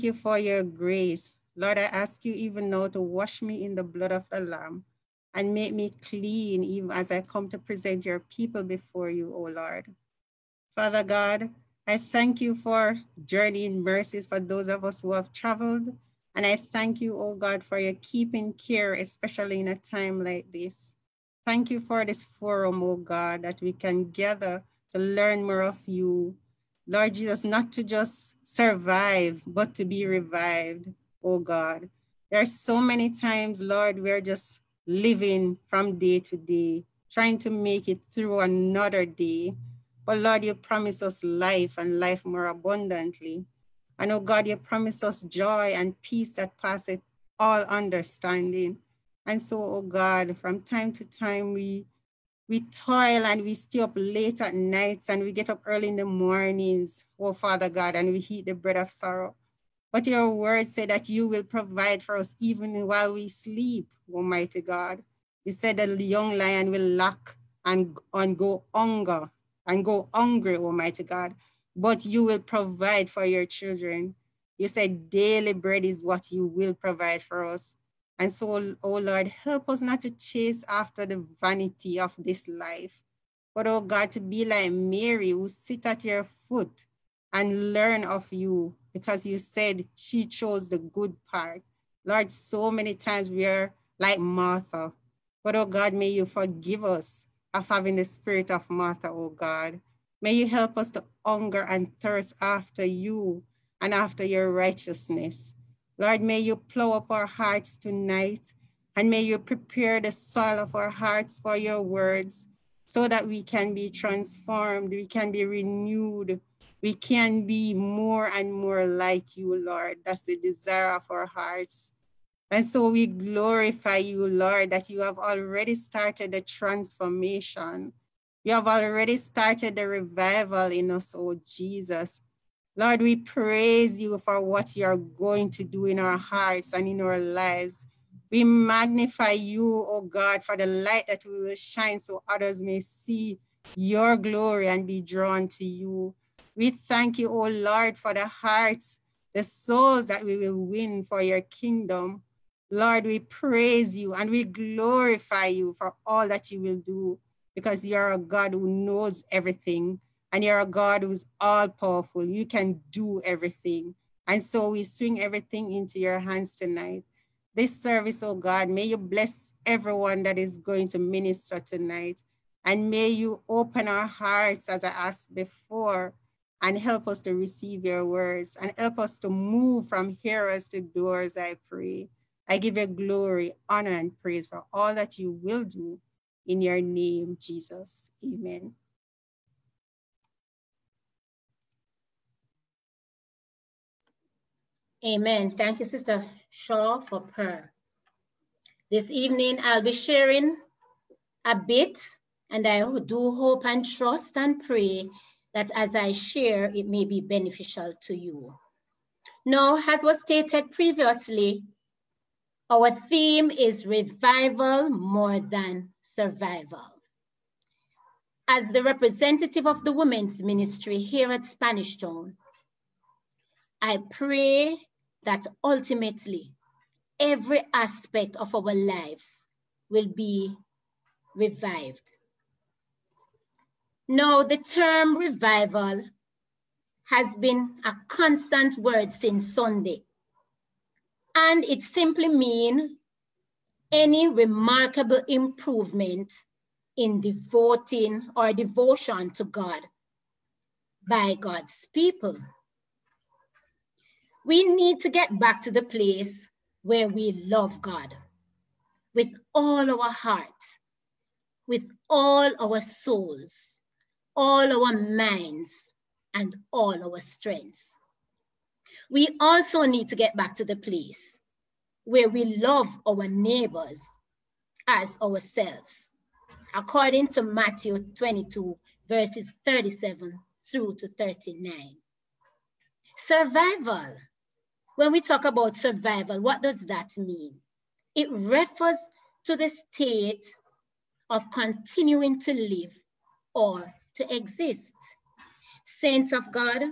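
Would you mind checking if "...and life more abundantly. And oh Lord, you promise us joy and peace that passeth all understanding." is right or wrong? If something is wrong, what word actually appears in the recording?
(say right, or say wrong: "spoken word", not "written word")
wrong: "God", not "Lord".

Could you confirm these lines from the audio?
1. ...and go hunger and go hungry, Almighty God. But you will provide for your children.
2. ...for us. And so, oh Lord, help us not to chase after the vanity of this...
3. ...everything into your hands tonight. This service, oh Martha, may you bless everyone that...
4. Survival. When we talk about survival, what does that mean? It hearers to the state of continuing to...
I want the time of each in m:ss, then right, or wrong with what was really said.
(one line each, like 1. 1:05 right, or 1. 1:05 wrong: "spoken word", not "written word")
1. 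1:08 right
2. 1:17 right
3. 2:45 wrong: "God", not "Martha"
4. 4:43 wrong: "refers", not "hearers".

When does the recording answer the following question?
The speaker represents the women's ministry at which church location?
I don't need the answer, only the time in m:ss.
3:41.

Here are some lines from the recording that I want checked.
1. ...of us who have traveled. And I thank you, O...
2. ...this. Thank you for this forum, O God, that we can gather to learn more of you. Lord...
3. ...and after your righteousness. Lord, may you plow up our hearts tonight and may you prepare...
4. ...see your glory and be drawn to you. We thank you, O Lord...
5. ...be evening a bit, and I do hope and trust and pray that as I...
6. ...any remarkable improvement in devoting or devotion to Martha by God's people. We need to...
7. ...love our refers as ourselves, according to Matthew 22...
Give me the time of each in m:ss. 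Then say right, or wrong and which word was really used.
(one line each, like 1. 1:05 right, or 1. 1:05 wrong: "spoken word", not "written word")
1. 0:14 right
2. 0:20 right
3. 1:43 right
4. 2:22 right
5. 3:19 wrong: "sharing", not "evening"
6. 4:03 wrong: "God", not "Martha"
7. 4:32 wrong: "neighbors", not "refers".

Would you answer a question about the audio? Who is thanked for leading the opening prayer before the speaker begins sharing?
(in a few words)
Sister Shaw.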